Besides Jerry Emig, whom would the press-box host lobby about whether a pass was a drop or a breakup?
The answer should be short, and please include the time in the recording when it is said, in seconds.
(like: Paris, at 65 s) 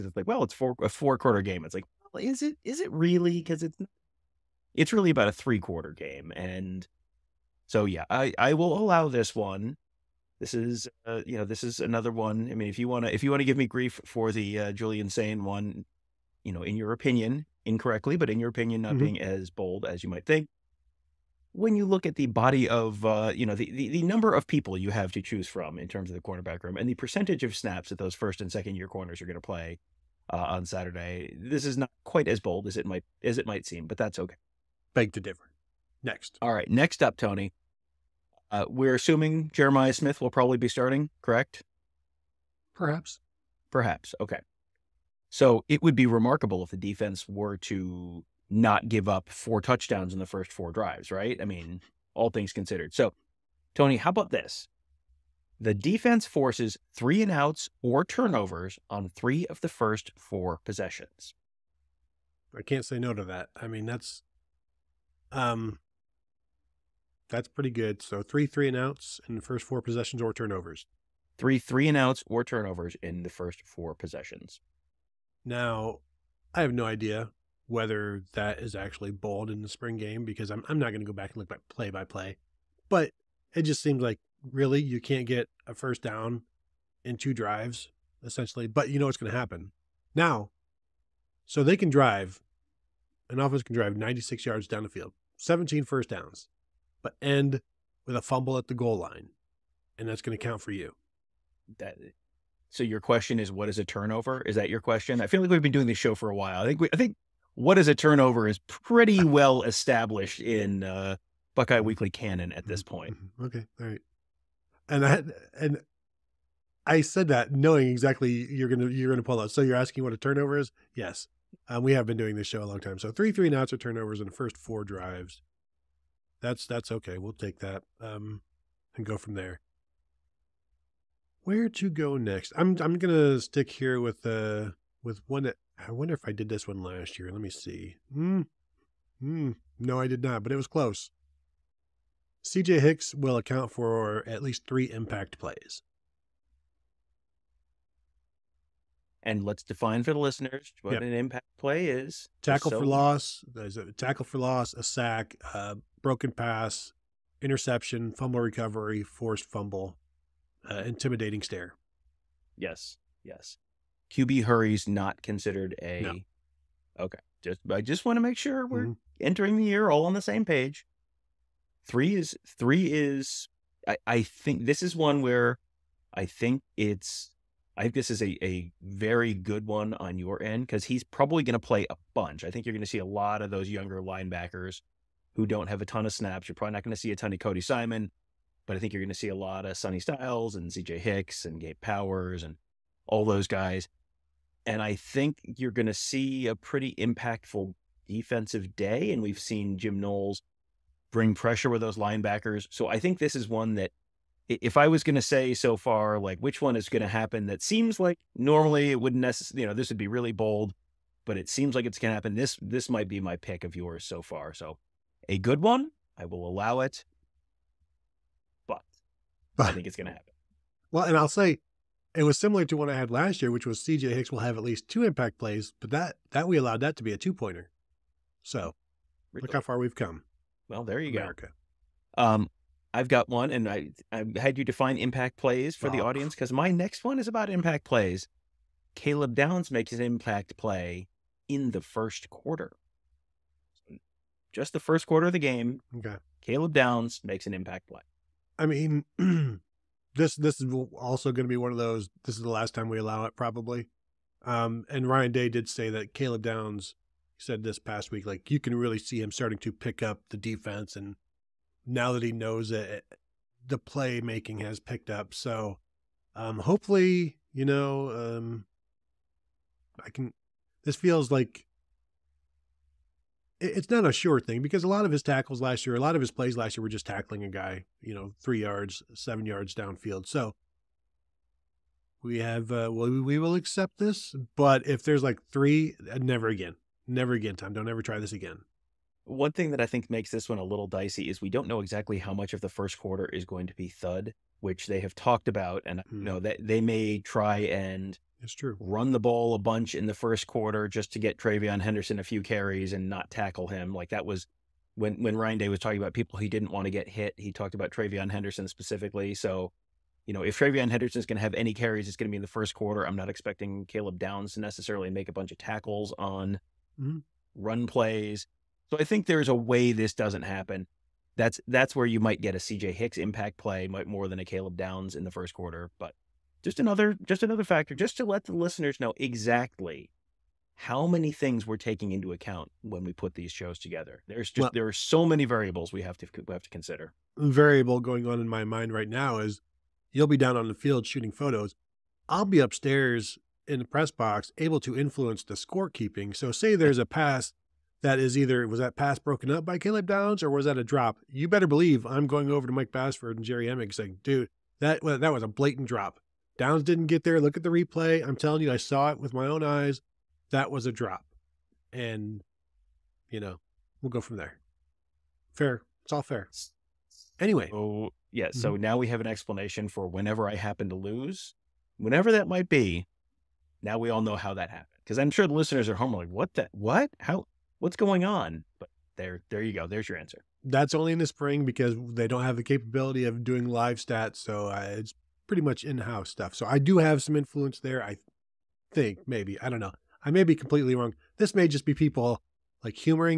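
Mike Bassford, at 352 s.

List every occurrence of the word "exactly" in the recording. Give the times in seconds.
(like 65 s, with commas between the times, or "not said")
117 s, 291 s, 329 s.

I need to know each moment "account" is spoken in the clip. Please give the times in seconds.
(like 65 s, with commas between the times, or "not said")
143 s, 332 s.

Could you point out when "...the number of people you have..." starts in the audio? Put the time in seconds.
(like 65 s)
23 s.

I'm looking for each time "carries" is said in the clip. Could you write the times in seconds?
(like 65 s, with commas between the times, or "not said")
302 s, 311 s.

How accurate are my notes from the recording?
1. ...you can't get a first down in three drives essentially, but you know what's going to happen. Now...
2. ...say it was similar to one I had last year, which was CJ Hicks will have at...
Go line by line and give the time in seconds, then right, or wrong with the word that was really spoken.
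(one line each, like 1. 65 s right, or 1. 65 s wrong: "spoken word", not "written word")
1. 84 s wrong: "two", not "three"
2. 221 s right.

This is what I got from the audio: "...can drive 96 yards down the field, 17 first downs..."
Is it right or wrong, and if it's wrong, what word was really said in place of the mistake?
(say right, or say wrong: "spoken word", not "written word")
right.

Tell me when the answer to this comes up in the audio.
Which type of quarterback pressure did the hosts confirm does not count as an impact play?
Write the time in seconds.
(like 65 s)
164 s.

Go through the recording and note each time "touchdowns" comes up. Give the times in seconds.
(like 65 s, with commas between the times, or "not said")
49 s.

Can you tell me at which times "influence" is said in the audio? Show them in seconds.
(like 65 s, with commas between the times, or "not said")
344 s, 387 s.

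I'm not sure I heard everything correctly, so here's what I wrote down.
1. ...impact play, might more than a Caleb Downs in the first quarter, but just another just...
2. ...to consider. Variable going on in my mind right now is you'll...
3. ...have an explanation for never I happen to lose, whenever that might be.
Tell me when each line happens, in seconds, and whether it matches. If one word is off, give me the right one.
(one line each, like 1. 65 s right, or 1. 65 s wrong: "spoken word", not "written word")
1. 323 s right
2. 336 s right
3. 369 s wrong: "whenever", not "never".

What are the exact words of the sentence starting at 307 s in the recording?
He talked about TreVeyon Henderson specifically.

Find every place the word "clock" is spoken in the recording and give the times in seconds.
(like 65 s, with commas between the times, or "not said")
not said.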